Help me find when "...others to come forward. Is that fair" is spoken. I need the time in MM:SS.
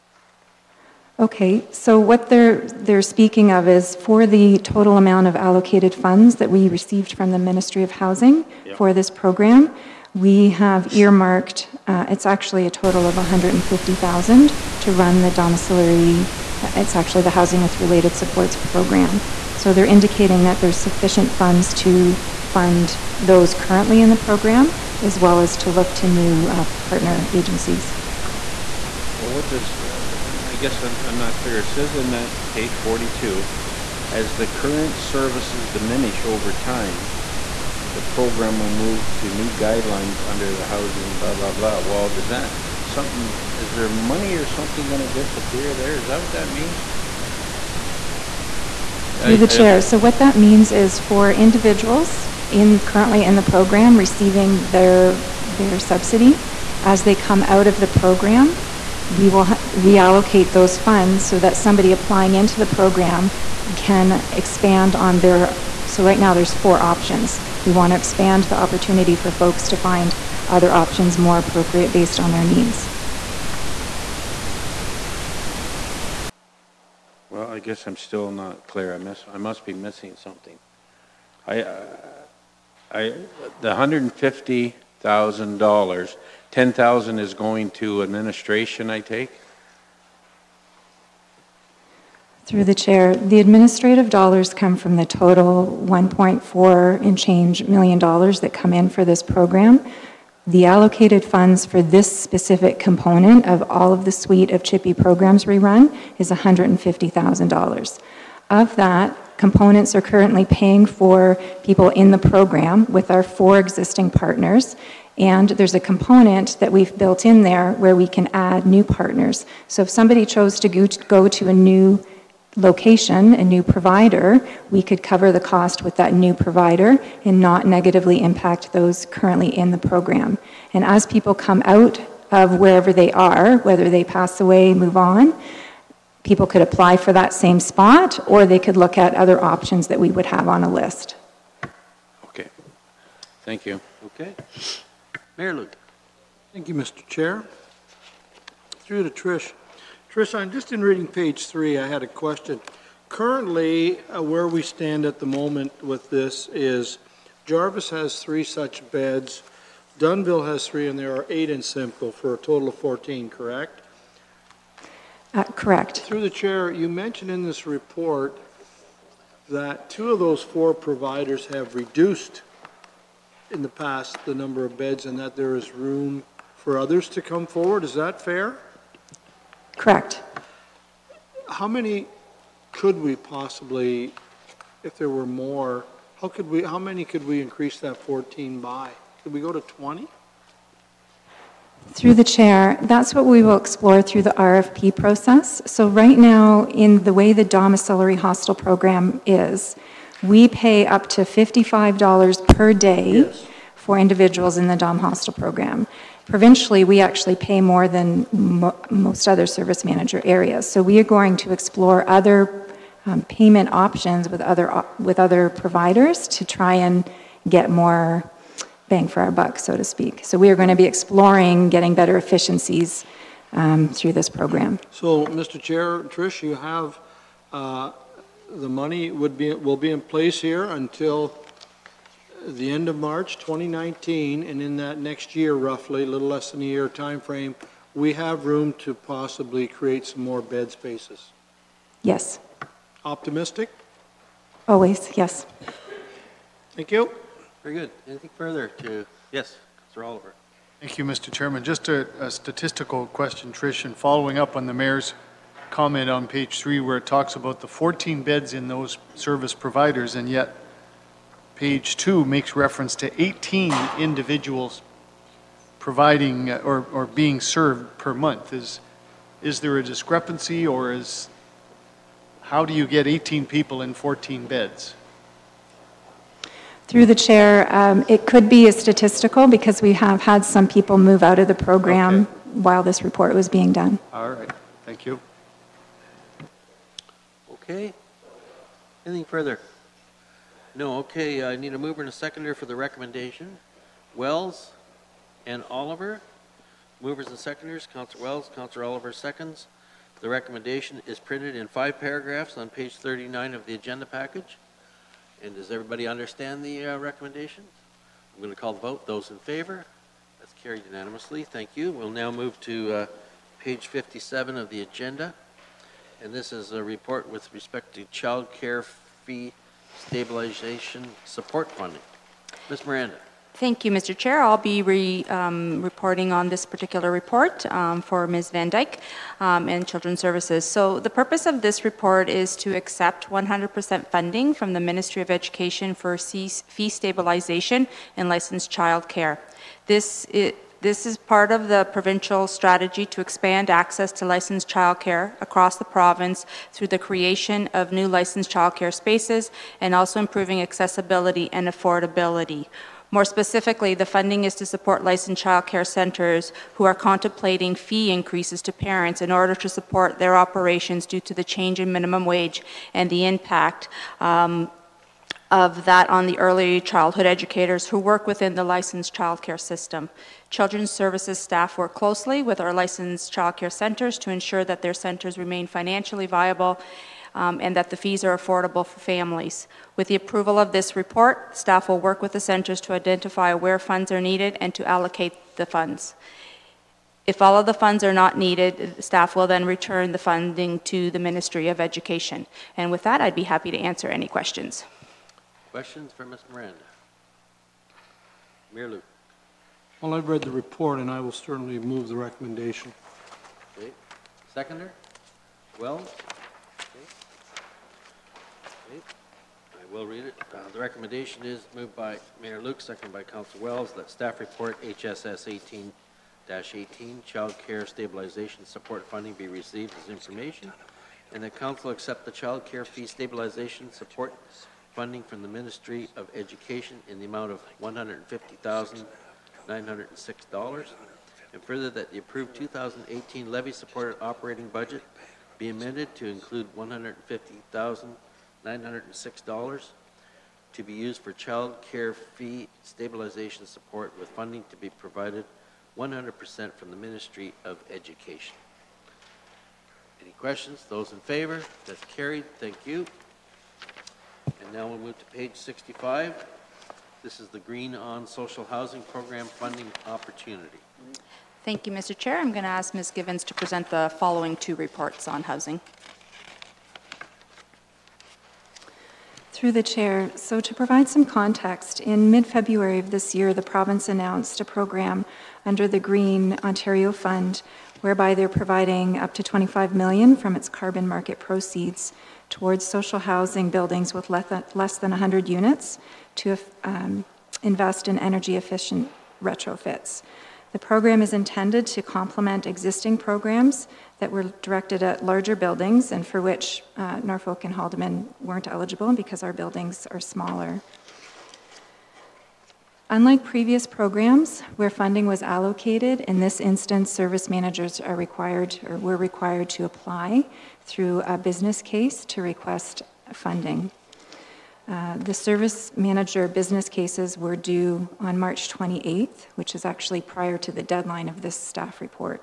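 02:56.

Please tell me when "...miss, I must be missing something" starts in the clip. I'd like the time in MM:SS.
01:18.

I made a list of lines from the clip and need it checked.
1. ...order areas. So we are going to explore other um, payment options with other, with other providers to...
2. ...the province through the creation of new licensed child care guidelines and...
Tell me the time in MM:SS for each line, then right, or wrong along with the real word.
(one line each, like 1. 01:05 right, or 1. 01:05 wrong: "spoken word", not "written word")
1. 03:29 wrong: "manager", not "order"
2. 05:45 wrong: "spaces", not "guidelines".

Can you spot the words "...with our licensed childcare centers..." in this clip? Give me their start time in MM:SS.
06:12.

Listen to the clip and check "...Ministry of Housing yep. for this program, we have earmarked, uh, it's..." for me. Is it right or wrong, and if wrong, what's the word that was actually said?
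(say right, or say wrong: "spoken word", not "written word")
right.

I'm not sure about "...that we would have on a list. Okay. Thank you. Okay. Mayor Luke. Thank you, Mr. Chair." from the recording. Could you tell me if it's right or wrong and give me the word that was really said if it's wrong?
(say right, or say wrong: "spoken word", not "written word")
right.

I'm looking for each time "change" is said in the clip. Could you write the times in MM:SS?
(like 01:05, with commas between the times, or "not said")
01:37, 06:01.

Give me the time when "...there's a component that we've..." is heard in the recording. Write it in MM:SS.
01:55.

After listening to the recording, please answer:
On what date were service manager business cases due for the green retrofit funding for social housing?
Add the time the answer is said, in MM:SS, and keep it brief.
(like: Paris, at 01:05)
March 28, at 08:38.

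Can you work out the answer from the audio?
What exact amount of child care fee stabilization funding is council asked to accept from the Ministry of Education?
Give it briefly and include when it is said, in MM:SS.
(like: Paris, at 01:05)
$150,906, at 07:07.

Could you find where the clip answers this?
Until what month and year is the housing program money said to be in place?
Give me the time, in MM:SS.
03:52.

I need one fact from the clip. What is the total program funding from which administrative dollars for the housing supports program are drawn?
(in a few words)
1.4 million dollars.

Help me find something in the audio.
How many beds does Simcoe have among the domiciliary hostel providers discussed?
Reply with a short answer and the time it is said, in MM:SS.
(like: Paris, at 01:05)
8, at 02:41.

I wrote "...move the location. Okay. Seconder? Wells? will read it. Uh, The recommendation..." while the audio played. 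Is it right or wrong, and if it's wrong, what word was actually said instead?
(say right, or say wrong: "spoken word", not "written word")
wrong: "recommendation", not "location".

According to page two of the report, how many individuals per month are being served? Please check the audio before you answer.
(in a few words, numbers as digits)
18.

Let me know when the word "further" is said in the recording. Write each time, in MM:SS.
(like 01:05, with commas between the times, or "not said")
04:08, 04:49, 07:11.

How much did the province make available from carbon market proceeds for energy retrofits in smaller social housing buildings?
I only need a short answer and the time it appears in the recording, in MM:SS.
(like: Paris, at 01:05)
25 million, at 07:59.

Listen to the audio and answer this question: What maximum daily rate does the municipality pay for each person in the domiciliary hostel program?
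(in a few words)
$55.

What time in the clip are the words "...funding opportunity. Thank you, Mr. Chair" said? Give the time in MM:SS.
07:39.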